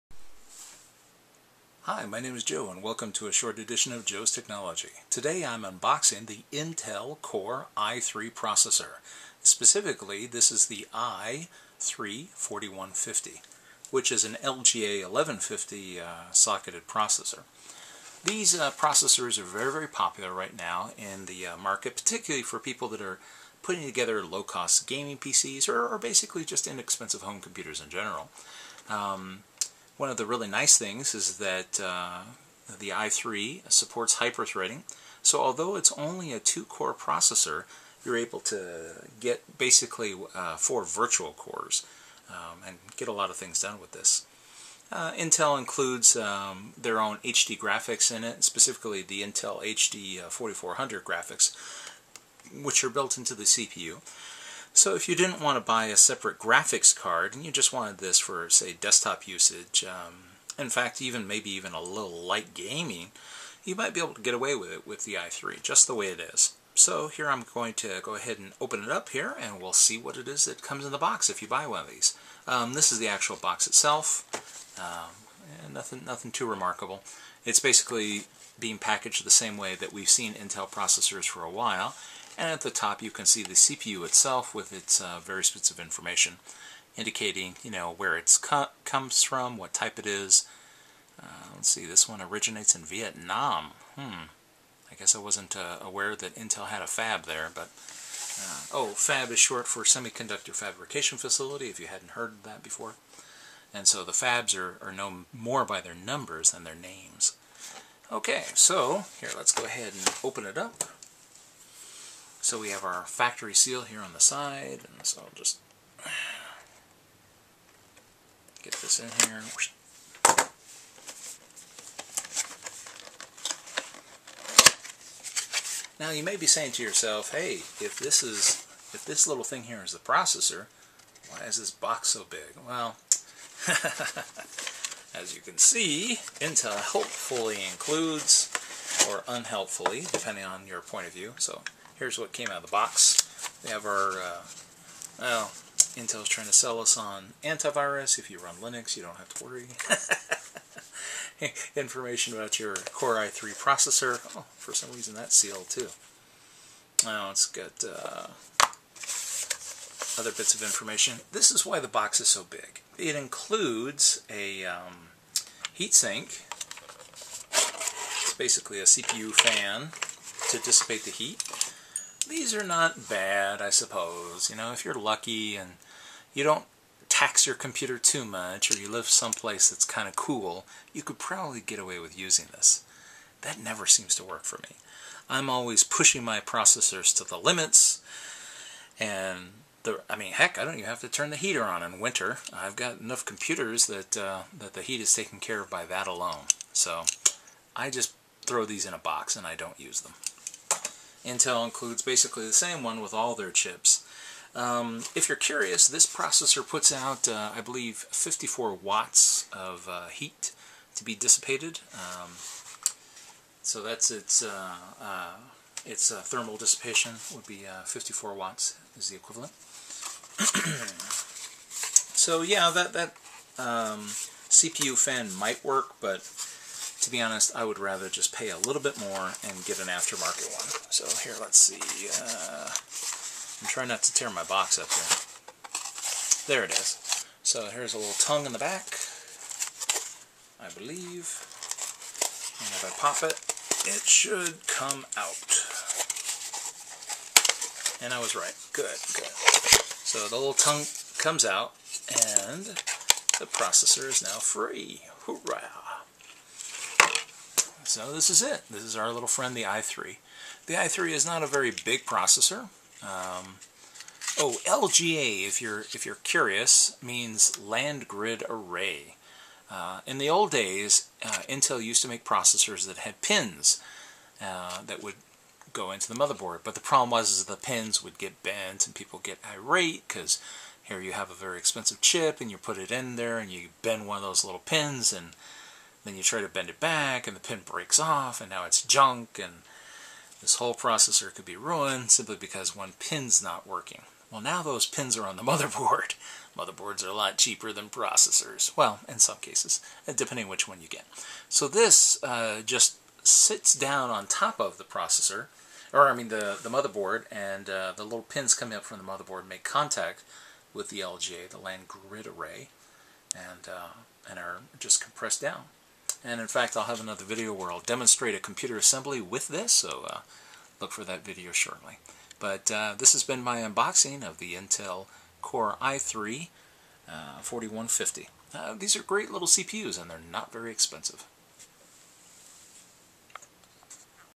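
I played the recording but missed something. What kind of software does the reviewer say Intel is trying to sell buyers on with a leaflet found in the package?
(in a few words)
antivirus.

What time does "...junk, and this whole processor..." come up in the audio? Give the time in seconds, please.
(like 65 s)
288 s.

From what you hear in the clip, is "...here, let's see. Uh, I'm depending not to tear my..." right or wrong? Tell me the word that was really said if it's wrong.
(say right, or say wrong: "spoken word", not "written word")
wrong: "trying", not "depending".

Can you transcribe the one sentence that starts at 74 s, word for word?
Um, eh, nothing, nothing too remarkable.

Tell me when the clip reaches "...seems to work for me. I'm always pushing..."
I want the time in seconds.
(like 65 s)
183 s.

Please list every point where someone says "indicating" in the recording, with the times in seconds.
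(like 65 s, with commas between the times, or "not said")
86 s.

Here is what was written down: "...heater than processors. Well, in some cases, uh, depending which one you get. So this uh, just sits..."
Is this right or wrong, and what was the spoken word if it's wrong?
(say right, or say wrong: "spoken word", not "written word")
wrong: "cheaper", not "heater".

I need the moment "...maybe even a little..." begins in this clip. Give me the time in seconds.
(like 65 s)
61 s.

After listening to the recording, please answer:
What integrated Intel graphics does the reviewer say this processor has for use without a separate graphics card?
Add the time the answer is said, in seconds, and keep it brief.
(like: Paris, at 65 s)
Intel HD 4400, at 49 s.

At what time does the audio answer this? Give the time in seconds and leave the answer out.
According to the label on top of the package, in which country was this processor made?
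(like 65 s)
92 s.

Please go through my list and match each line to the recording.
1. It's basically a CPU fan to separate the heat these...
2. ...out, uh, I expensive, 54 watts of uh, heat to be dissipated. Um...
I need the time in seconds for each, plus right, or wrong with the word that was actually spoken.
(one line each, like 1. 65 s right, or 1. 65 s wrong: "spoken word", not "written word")
1. 167 s wrong: "dissipate", not "separate"
2. 206 s wrong: "believe", not "expensive".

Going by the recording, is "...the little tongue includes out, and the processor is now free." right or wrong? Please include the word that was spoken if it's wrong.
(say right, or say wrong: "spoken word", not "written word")
wrong: "comes", not "includes".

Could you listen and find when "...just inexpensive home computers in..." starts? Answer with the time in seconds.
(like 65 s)
26 s.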